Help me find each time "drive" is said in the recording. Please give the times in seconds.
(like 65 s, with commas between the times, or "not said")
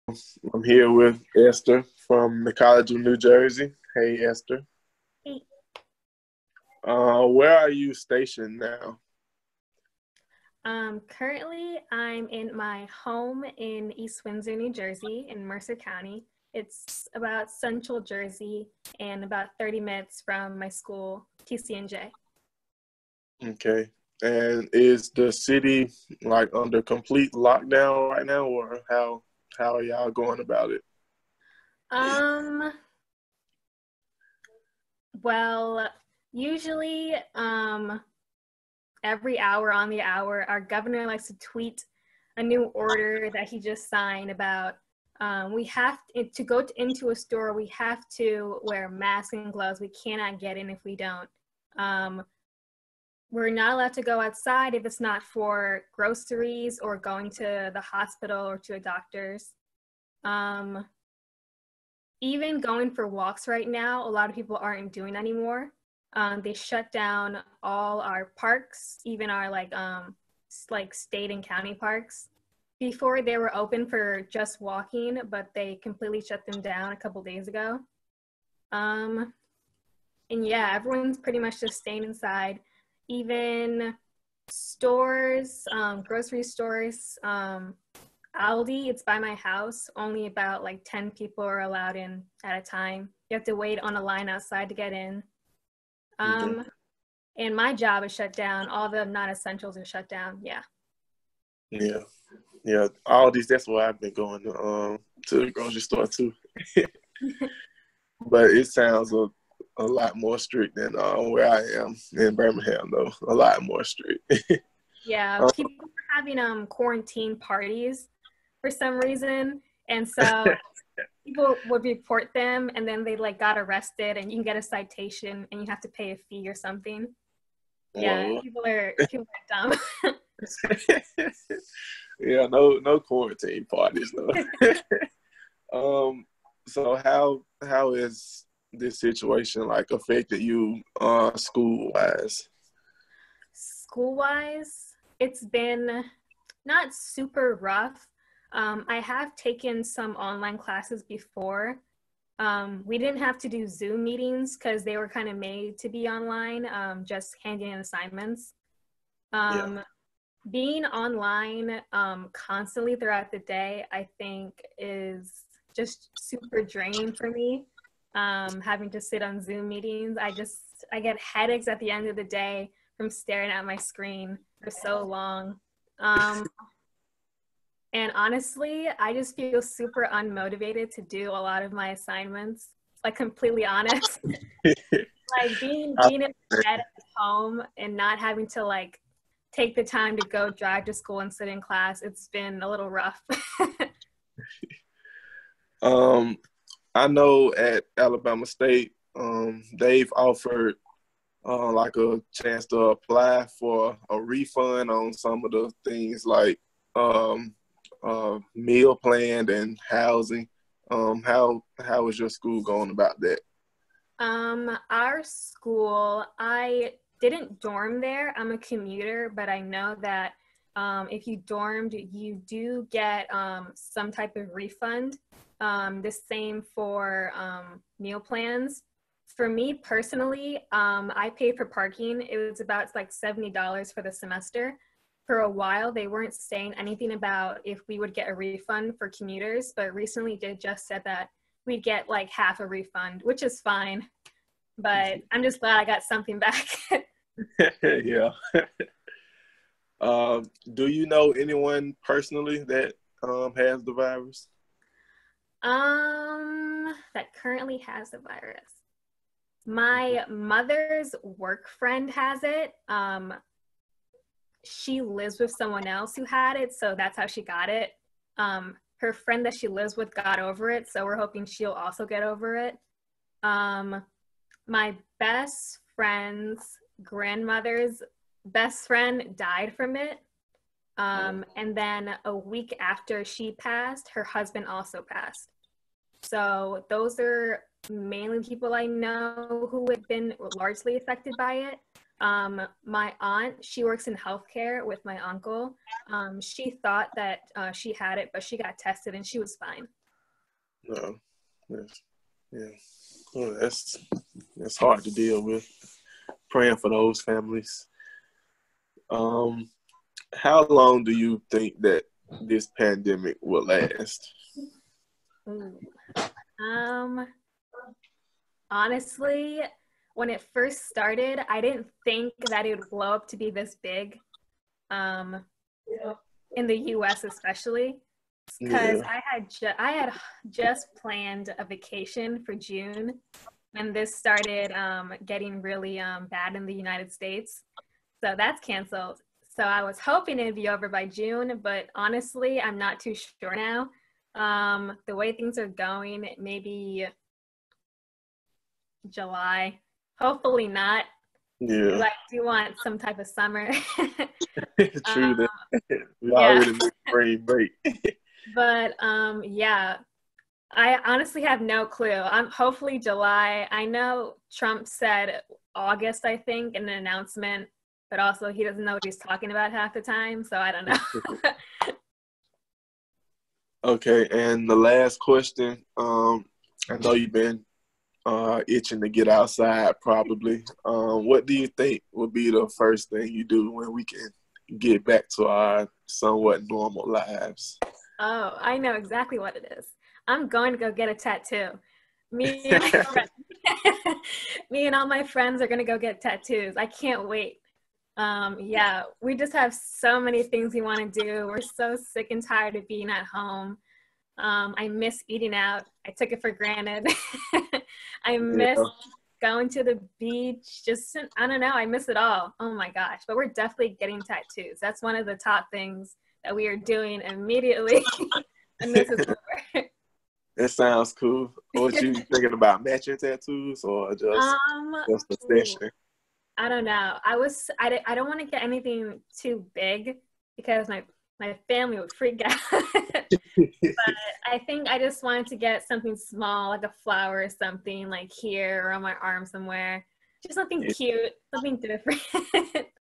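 190 s.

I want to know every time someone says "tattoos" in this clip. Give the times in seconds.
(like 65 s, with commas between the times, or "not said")
391 s, 396 s, 414 s, 423 s.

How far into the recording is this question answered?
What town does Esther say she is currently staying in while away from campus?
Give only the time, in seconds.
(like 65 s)
13 s.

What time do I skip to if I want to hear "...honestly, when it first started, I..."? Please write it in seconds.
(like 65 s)
318 s.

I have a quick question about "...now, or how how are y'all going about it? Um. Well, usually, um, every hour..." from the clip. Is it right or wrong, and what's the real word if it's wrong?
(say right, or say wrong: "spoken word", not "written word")
right.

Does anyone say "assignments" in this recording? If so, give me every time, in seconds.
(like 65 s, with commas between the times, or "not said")
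157 s, 181 s.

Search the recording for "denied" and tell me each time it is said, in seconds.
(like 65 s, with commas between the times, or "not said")
not said.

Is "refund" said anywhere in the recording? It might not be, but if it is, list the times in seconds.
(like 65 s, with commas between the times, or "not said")
204 s, 224 s, 238 s, 242 s.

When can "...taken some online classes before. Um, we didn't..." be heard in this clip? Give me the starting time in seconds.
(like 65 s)
149 s.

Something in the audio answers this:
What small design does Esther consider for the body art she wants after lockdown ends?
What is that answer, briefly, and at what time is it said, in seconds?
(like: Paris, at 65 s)
A flower, at 436 s.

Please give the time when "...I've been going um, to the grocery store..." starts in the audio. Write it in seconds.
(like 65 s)
103 s.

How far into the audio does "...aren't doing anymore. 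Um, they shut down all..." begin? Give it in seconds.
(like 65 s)
64 s.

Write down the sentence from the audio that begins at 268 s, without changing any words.
Um, her friend that she lives with got over it, so we're hoping she'll also get over it.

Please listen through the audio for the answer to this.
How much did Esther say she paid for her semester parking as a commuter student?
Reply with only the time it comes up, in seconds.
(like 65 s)
233 s.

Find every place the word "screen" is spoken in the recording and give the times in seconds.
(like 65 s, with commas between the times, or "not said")
173 s.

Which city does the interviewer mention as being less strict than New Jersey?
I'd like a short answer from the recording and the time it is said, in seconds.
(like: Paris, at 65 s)
Birmingham, at 112 s.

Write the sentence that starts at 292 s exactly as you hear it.
Um, my aunt, she works in healthcare with my uncle.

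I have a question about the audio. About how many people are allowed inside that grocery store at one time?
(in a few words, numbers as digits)
10.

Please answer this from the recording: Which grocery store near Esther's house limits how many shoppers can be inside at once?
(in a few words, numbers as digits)
Aldi.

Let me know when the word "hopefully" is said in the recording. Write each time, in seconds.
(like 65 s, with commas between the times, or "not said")
350 s, 362 s.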